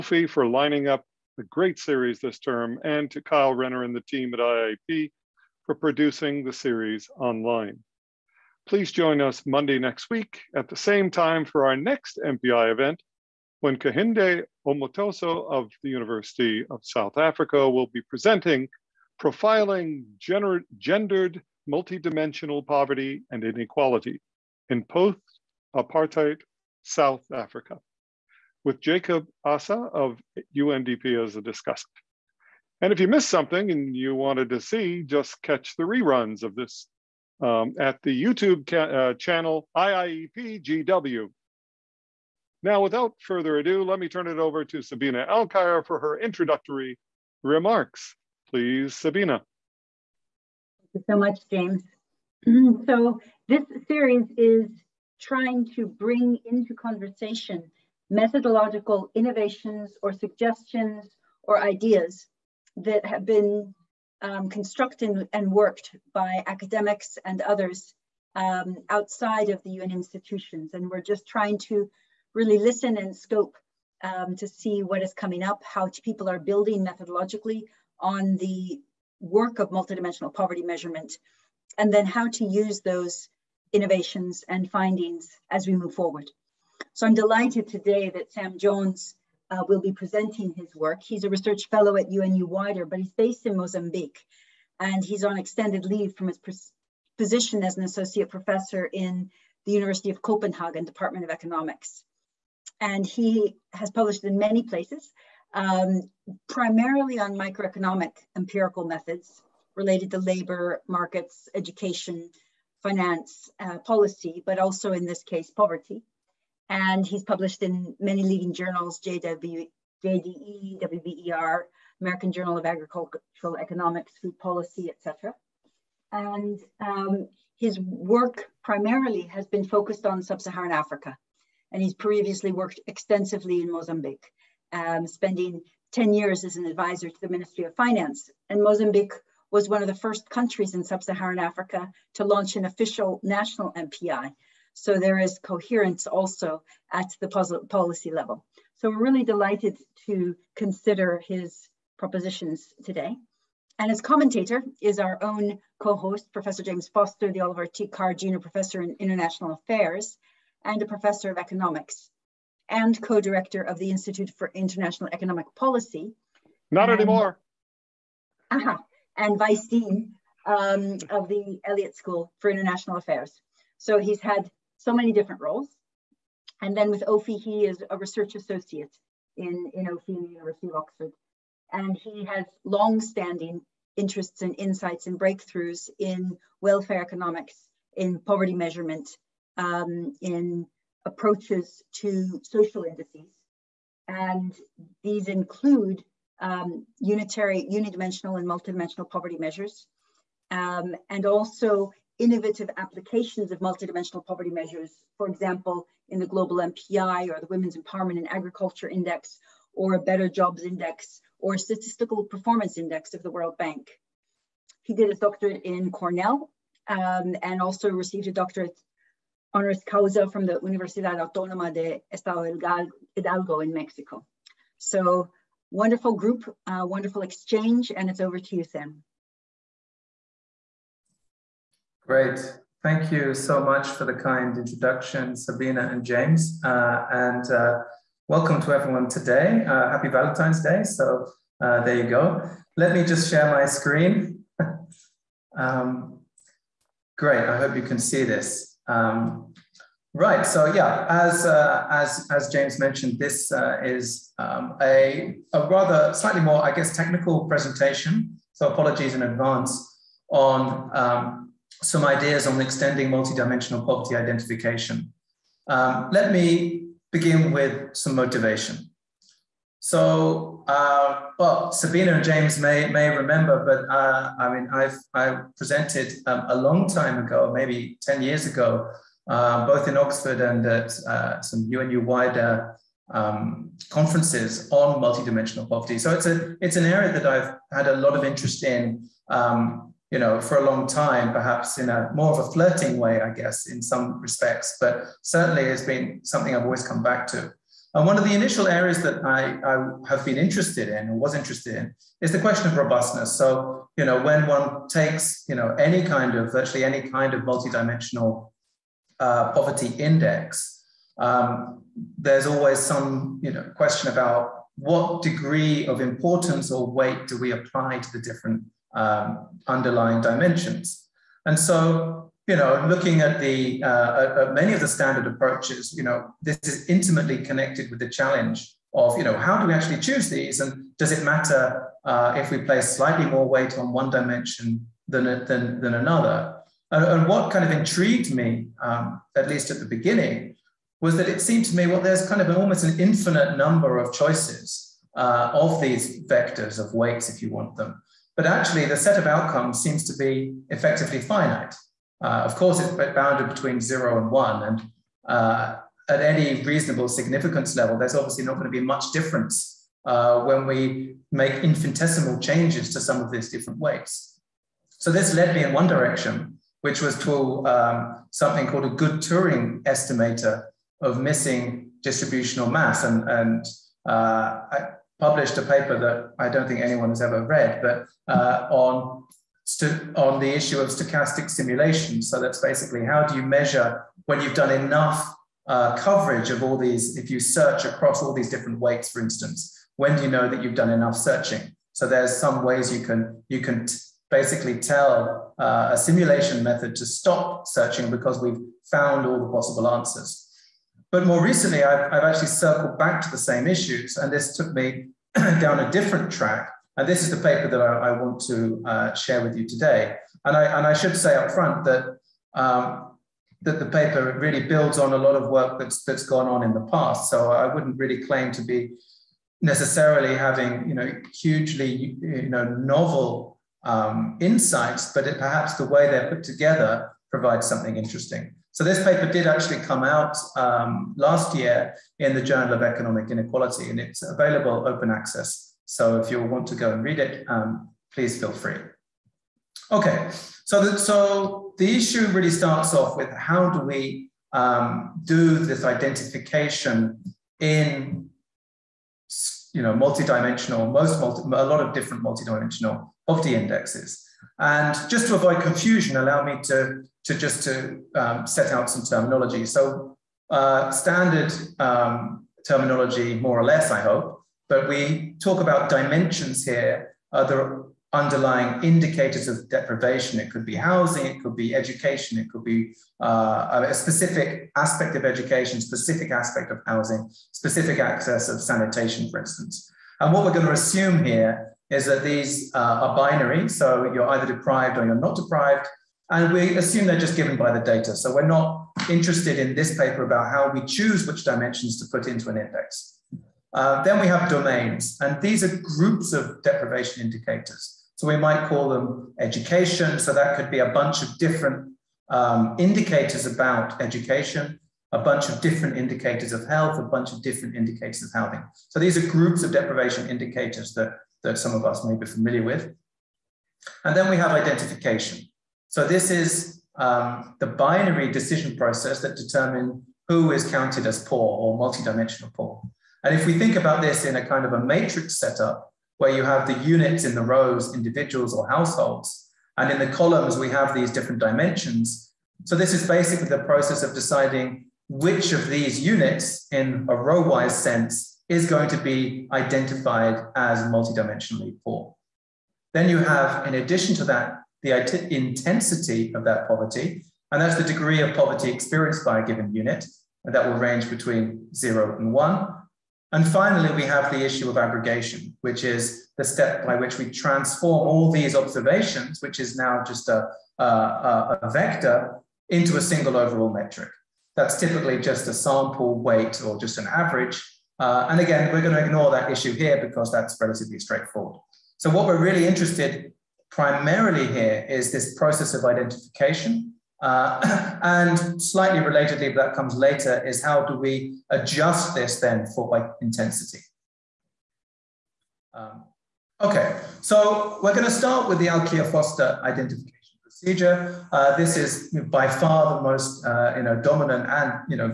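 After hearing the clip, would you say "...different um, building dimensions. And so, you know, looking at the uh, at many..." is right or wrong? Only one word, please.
wrong.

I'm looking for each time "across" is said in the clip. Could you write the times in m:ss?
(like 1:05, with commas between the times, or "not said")
6:27.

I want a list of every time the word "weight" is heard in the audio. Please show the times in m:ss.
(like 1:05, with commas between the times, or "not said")
5:16, 5:33, 5:46, 6:03, 6:28, 9:26.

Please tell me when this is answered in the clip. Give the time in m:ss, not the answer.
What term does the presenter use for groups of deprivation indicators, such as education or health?
8:14.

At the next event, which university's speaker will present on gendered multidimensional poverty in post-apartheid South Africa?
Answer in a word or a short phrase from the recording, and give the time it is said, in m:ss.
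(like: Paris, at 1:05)
University of South Africa, at 0:15.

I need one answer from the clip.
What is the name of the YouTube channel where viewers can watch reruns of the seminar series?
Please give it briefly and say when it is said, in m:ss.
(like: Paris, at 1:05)
IIEPGW, at 0:39.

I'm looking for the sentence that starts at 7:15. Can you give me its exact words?
So if you want to go and read it, um, please feel free.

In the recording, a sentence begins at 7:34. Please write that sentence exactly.
And just to avoid confusion, allow me to to just to um, set out some terminology.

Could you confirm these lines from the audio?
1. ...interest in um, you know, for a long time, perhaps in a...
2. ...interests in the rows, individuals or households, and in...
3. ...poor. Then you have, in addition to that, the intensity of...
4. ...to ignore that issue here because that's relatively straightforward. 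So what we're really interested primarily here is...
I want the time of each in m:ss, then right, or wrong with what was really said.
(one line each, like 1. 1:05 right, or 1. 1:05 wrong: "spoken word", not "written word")
1. 4:48 right
2. 8:46 wrong: "units", not "interests"
3. 9:01 right
4. 9:28 right.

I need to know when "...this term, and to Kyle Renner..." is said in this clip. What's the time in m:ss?
0:02.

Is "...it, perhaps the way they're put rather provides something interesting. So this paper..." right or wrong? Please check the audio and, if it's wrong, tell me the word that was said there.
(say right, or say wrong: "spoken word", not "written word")
wrong: "together", not "rather".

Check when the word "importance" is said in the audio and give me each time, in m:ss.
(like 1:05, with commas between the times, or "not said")
5:15.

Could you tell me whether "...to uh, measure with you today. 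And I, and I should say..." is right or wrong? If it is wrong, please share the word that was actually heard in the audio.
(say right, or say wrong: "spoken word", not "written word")
wrong: "share", not "measure".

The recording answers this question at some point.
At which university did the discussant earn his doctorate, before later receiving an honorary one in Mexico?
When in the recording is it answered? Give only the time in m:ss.
3:35.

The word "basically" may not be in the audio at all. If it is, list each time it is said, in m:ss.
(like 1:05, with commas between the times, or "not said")
6:22, 6:34, 8:53.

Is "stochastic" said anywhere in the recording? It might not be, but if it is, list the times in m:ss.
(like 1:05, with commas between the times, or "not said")
6:20.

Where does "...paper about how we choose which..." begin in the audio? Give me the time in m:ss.
8:09.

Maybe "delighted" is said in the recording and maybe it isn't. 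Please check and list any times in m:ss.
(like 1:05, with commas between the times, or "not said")
1:27, 2:29.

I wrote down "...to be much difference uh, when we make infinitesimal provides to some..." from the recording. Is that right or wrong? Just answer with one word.
wrong.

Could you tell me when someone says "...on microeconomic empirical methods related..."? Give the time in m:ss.
1:47.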